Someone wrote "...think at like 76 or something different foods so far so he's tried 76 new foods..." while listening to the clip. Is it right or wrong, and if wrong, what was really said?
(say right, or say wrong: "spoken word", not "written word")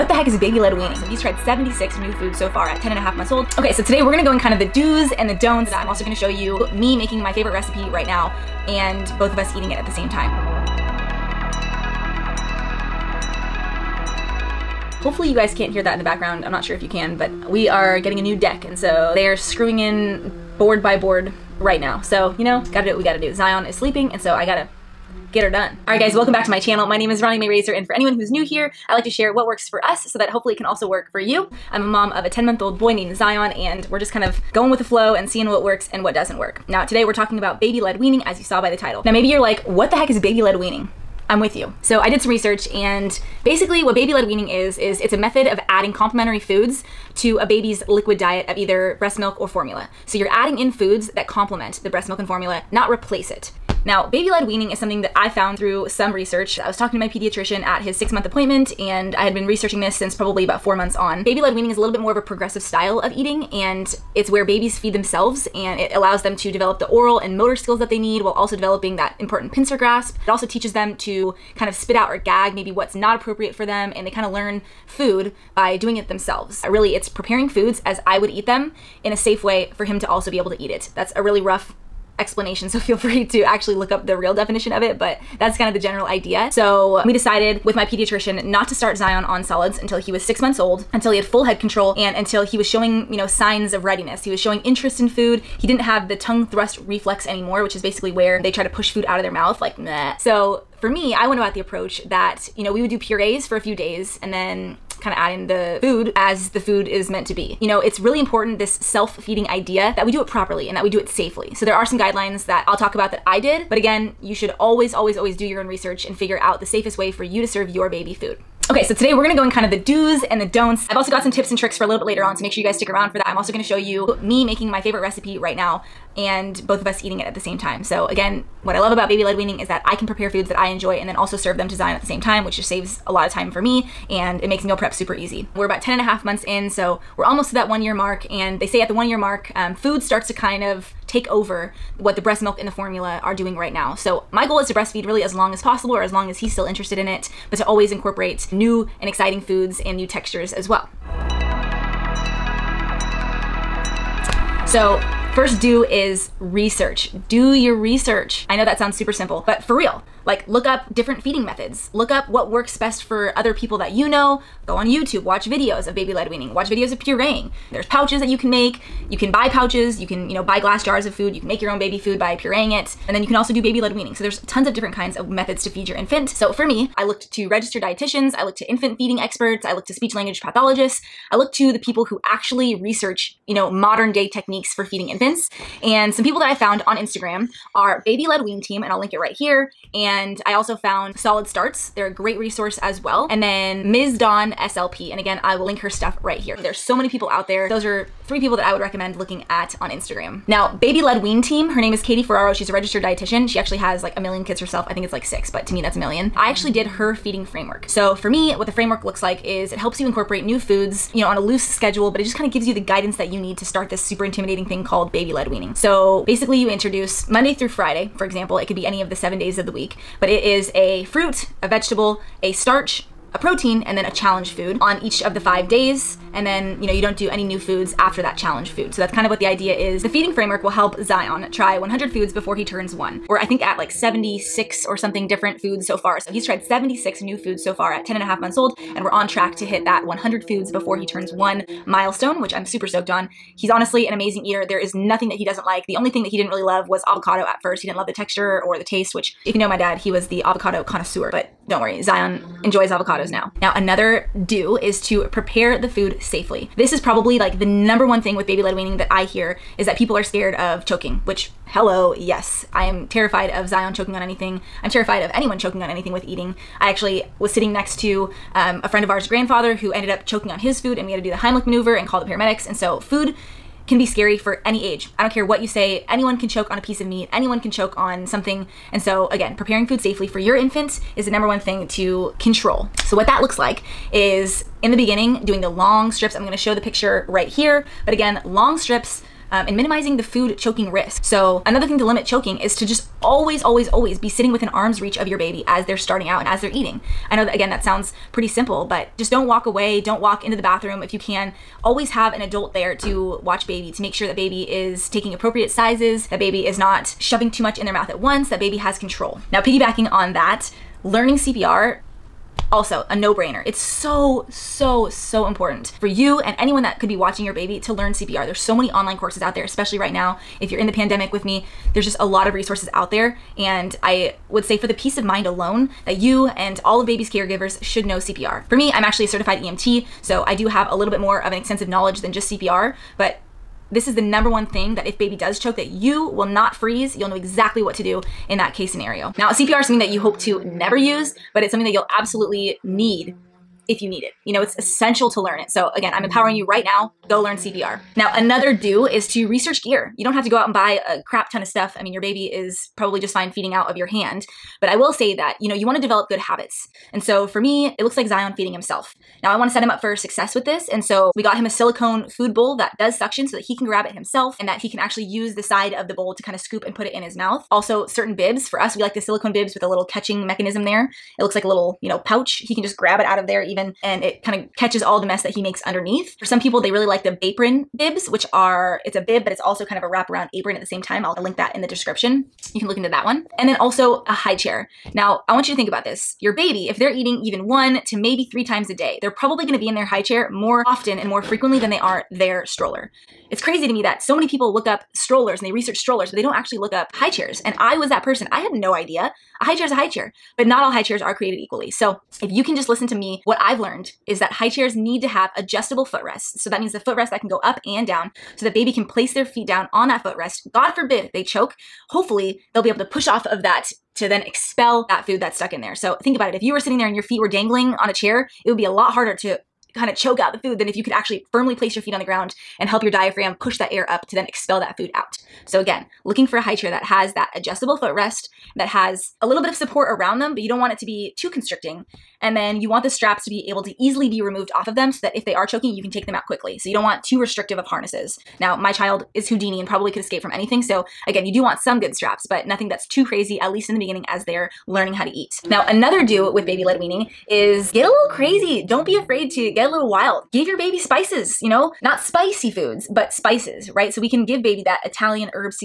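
right.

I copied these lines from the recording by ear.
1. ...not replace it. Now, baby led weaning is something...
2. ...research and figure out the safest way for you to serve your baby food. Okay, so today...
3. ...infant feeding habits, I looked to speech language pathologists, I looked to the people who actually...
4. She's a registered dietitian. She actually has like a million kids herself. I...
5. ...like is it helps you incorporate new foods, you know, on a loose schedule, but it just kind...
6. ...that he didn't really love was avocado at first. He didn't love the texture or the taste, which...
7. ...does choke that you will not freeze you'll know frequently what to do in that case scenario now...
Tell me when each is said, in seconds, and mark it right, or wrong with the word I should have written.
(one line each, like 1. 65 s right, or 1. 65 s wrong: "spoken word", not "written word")
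1. 52 s right
2. 115 s right
3. 178 s wrong: "experts", not "habits"
4. 202 s right
5. 209 s right
6. 246 s right
7. 335 s wrong: "exactly", not "frequently".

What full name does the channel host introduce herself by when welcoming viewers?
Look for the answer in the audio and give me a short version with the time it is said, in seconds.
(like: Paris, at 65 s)
Ronnie Mae Razor, at 27 s.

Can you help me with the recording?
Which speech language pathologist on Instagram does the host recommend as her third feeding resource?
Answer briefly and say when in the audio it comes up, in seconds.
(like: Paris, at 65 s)
Ms. Dawn SLP, at 193 s.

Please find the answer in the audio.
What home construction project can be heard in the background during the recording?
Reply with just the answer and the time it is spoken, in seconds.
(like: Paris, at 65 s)
a new deck, at 18 s.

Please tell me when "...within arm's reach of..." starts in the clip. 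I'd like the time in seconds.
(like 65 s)
294 s.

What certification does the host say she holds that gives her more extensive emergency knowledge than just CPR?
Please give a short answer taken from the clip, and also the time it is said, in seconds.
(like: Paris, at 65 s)
certified EMT, at 329 s.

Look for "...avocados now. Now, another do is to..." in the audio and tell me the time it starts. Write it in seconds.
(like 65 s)
252 s.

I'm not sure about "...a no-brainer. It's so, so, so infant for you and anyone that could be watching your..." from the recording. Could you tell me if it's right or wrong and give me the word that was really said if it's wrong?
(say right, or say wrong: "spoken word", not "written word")
wrong: "important", not "infant".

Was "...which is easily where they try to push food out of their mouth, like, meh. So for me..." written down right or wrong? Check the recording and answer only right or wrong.
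wrong.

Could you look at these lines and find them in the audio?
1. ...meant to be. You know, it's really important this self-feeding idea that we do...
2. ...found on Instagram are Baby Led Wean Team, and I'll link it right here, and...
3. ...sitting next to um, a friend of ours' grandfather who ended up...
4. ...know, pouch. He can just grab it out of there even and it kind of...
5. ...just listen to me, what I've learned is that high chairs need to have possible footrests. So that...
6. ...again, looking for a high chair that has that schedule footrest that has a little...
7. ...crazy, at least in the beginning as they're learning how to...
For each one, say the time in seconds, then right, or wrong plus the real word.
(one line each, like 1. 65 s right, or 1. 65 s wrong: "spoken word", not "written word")
1. 107 s right
2. 186 s right
3. 267 s right
4. 372 s right
5. 402 s wrong: "adjustable", not "possible"
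6. 425 s wrong: "adjustable", not "schedule"
7. 443 s right.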